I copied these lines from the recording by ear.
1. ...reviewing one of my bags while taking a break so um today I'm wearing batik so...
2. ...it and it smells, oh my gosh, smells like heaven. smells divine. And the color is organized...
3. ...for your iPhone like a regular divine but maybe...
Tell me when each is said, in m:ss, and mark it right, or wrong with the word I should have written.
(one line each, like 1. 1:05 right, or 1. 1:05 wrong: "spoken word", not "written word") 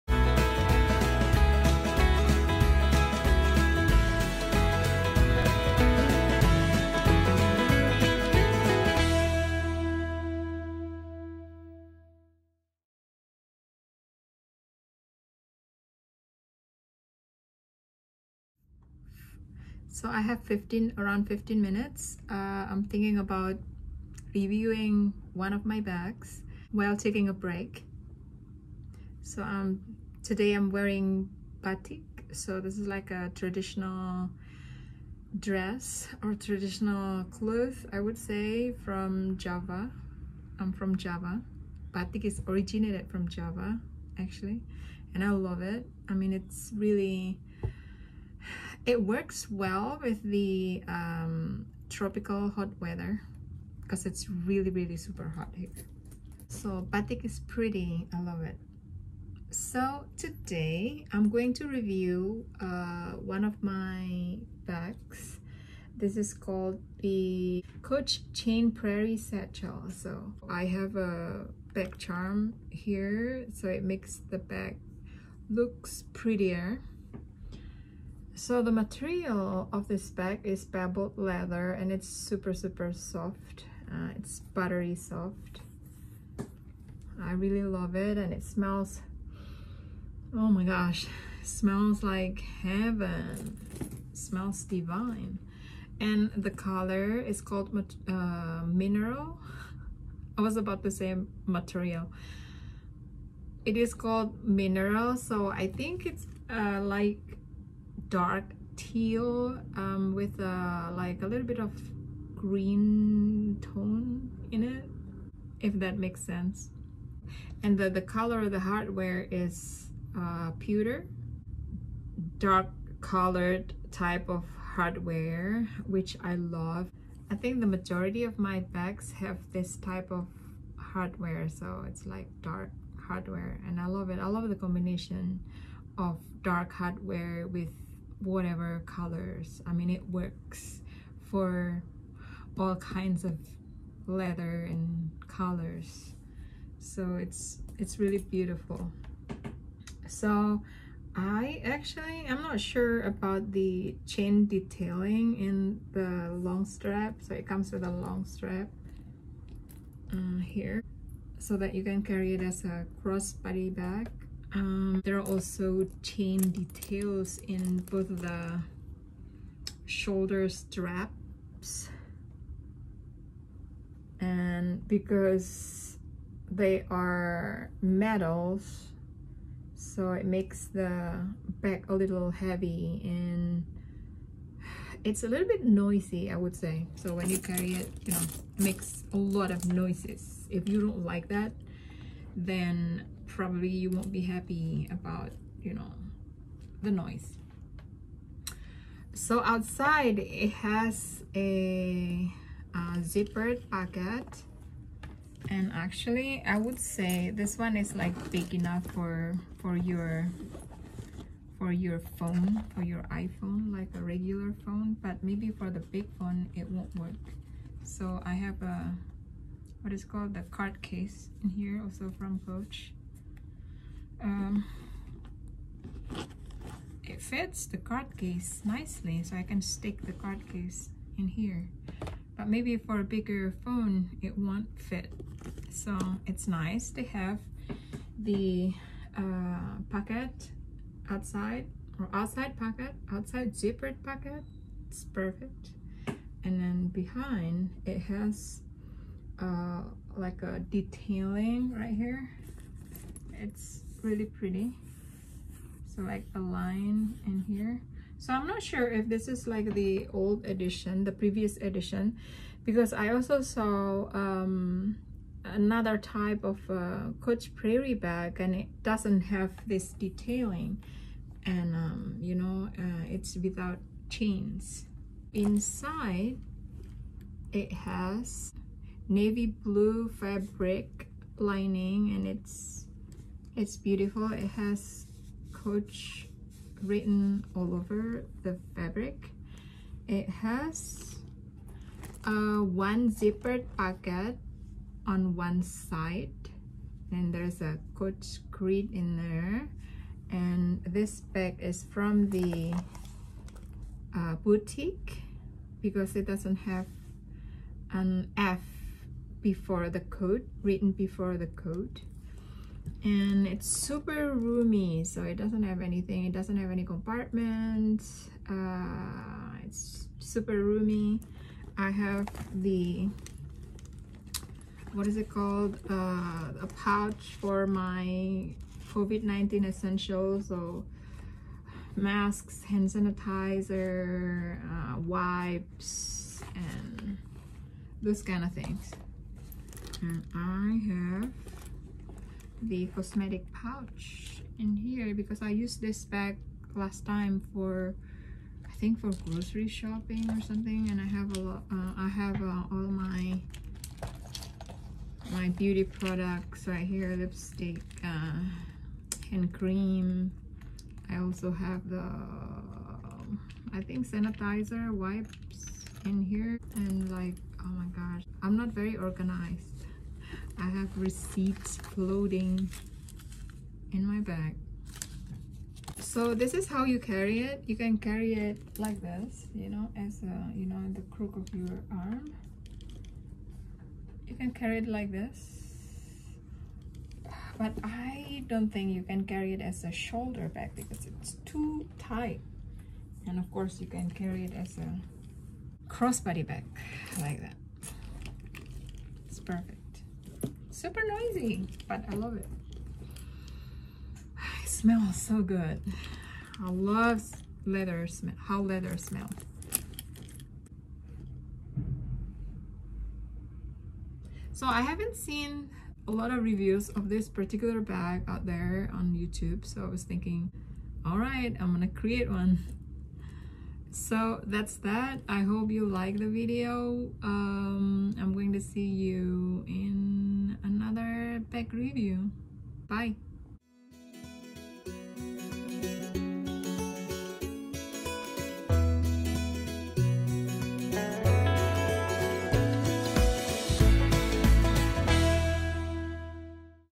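1. 0:24 right
2. 1:27 wrong: "called", not "organized"
3. 3:32 wrong: "phone", not "divine".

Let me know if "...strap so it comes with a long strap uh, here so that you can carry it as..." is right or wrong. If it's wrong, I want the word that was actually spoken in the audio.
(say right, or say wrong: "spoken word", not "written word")
right.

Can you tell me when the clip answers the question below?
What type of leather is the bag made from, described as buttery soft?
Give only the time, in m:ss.
1:20.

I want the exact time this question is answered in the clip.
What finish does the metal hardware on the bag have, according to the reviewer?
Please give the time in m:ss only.
2:00.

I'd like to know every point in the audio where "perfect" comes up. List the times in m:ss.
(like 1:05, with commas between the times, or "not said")
4:05, 6:39.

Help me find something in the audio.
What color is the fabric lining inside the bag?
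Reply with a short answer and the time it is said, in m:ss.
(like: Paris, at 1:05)
Navy blue, at 4:39.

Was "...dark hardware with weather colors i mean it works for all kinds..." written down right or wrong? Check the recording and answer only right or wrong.
wrong.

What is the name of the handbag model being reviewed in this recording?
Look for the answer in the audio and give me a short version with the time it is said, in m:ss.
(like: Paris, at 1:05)
Coach Chain Prairie Satchel, at 1:07.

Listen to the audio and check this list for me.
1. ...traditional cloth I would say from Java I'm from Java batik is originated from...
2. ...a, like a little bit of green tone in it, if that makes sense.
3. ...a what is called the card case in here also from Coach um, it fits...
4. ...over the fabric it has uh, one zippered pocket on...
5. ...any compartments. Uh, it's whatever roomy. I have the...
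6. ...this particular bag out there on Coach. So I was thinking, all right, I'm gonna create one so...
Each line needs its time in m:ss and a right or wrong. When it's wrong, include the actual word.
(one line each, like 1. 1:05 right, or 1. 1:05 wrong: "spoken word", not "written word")
1. 0:36 right
2. 1:50 right
3. 3:38 right
4. 4:47 right
5. 5:16 wrong: "super", not "whatever"
6. 6:57 wrong: "YouTube", not "Coach".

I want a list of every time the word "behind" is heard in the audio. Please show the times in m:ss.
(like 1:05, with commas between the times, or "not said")
4:06.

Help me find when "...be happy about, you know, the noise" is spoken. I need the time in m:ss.
3:14.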